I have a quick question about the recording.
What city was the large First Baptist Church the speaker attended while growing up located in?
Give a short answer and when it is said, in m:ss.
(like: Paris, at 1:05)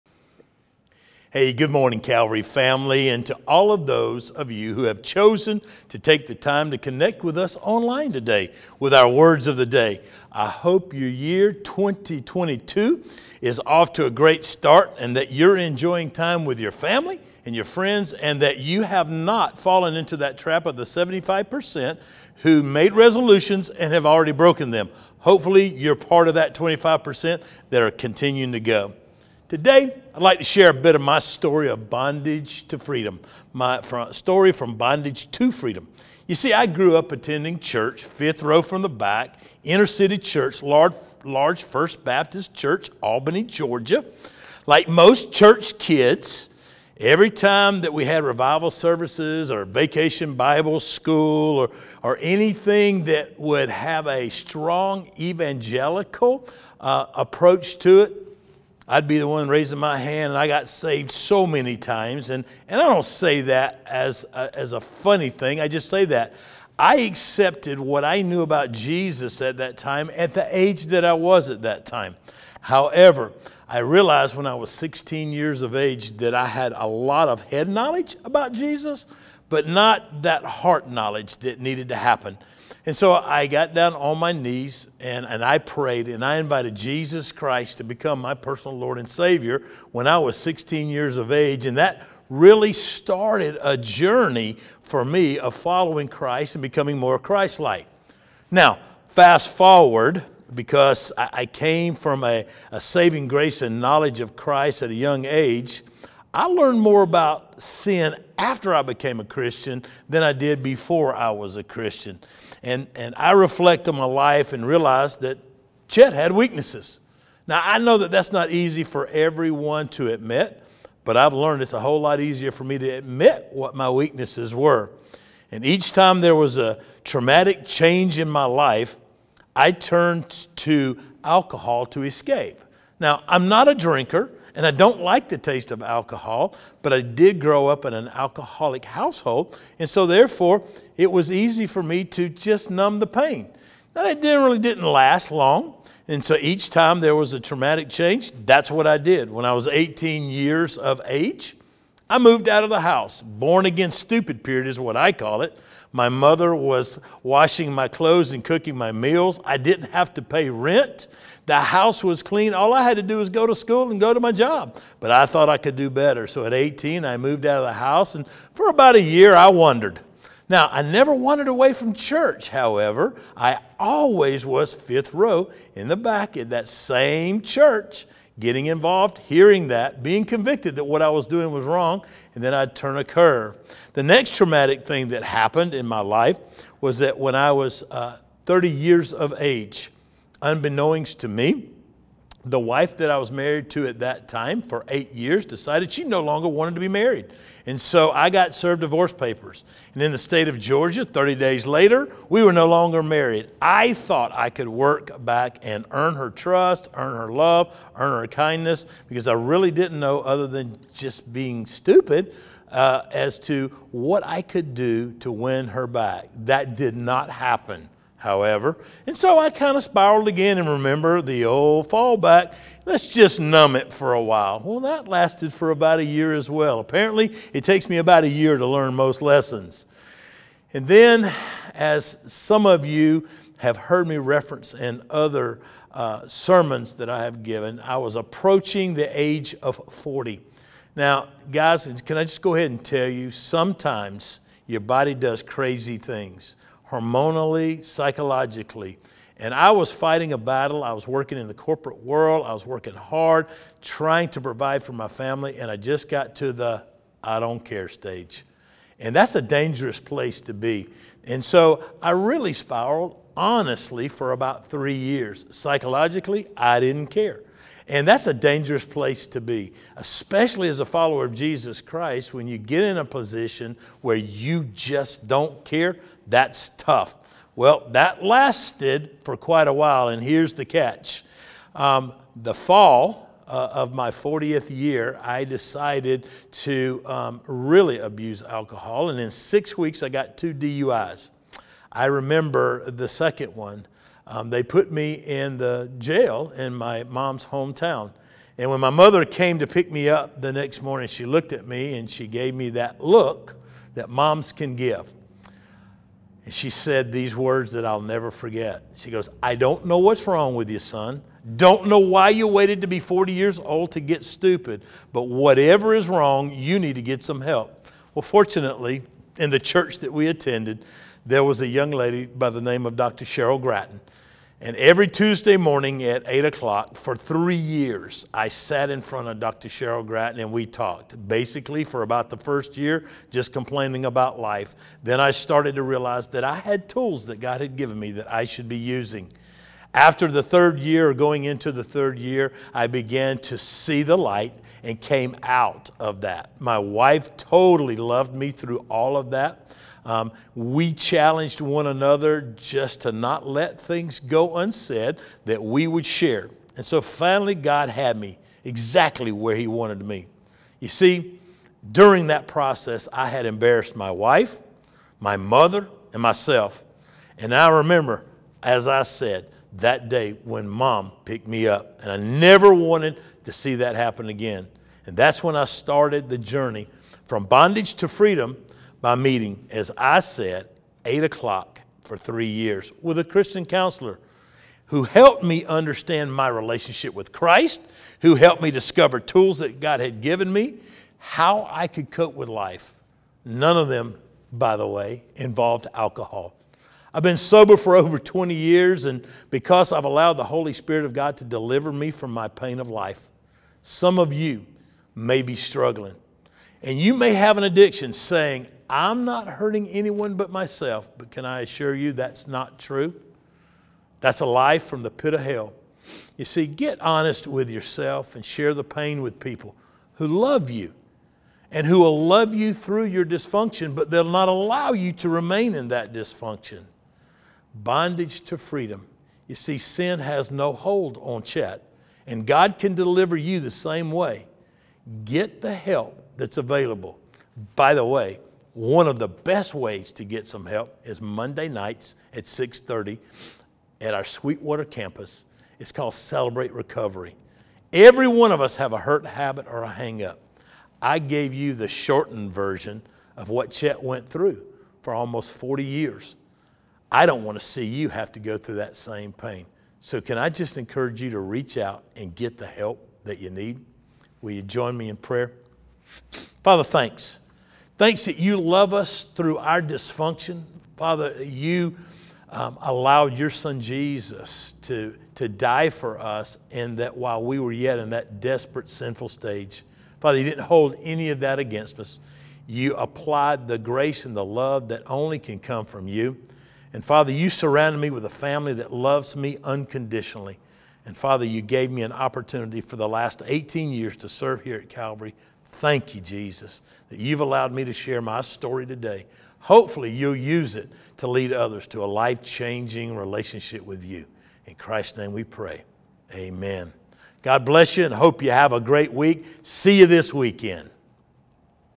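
Albany, Georgia, at 0:43.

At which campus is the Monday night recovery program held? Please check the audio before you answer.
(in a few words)
Sweetwater.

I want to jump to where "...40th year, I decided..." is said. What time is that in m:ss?
4:44.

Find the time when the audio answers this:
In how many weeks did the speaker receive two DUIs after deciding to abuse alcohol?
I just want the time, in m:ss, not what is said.
4:49.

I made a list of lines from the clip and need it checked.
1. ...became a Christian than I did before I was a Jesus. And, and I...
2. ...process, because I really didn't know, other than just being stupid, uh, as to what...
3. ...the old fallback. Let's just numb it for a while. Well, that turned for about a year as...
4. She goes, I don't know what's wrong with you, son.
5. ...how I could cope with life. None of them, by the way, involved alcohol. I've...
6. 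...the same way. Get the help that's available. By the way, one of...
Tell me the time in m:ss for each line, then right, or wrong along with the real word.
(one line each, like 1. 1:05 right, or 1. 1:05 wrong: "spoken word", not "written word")
1. 1:48 wrong: "Christian", not "Jesus"
2. 3:28 wrong: "kindness", not "process"
3. 3:41 wrong: "lasted", not "turned"
4. 5:08 right
5. 6:31 right
6. 7:13 right.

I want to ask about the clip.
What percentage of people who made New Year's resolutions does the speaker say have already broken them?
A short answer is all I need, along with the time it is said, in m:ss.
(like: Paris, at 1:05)
75%, at 0:20.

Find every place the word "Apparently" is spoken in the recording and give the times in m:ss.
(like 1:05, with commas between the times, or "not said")
3:46.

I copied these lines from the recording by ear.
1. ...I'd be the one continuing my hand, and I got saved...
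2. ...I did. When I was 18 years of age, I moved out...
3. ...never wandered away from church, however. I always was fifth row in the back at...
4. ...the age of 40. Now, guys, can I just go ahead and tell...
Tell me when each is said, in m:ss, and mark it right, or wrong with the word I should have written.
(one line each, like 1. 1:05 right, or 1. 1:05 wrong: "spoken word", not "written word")
1. 0:58 wrong: "raising", not "continuing"
2. 2:28 right
3. 2:50 right
4. 3:58 right.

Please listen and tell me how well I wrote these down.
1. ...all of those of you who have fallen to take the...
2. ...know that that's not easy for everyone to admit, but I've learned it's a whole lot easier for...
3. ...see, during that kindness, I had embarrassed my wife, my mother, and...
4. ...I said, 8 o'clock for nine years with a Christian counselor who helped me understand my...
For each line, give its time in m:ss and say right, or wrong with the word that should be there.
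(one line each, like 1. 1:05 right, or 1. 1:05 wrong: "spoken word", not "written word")
1. 0:03 wrong: "chosen", not "fallen"
2. 1:57 right
3. 6:00 wrong: "process", not "kindness"
4. 6:19 wrong: "three", not "nine".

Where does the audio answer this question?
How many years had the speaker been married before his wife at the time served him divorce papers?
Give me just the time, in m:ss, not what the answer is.
3:14.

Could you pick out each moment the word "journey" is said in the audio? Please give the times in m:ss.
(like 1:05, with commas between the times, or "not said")
1:33, 6:16.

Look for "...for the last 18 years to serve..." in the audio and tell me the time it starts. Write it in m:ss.
8:12.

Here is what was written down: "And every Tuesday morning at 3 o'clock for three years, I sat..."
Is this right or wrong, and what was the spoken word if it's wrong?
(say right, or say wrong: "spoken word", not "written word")
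wrong: "8", not "3".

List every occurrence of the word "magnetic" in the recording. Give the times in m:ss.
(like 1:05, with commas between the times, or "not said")
not said.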